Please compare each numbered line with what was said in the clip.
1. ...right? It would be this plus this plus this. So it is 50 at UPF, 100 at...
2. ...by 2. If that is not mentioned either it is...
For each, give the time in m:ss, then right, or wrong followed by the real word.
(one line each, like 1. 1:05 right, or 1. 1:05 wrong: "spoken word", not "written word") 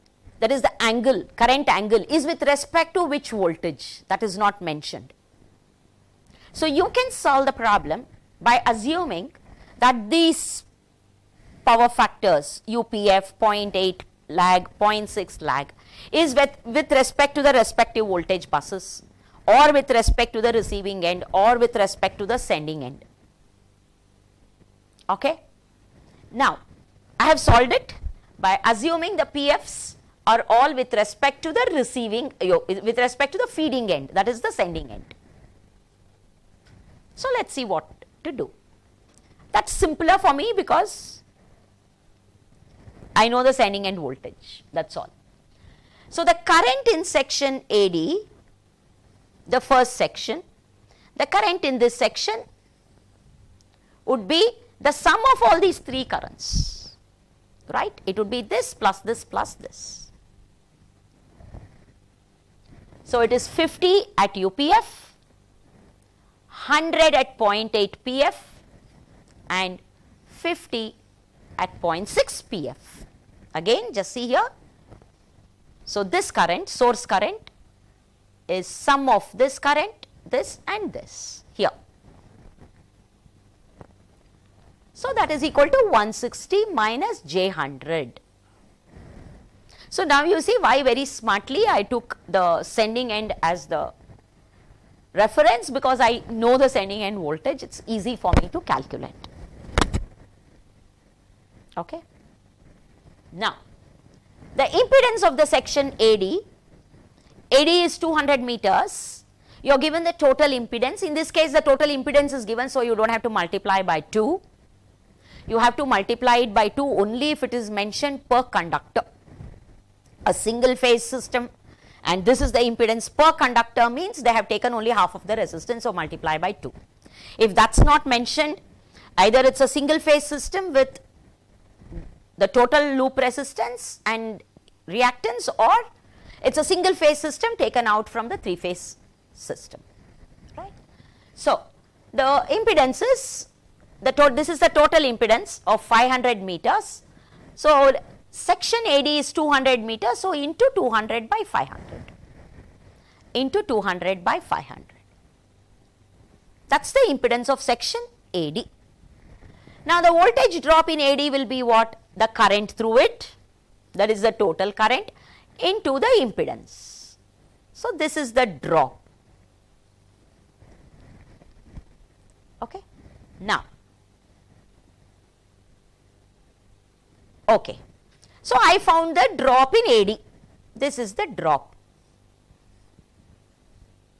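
1. 0:57 right
2. 2:06 right.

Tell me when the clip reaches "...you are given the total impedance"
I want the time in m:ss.
1:49.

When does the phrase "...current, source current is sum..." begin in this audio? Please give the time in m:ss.
1:16.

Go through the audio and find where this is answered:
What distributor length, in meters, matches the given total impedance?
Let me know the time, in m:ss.
2:25.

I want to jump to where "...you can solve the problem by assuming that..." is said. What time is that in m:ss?
0:06.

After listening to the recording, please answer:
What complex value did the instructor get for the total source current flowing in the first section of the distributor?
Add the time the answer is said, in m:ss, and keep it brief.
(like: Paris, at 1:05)
160 - j100, at 1:25.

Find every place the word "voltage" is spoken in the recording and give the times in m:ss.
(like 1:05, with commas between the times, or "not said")
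0:03, 0:18, 0:43, 1:37, 2:40.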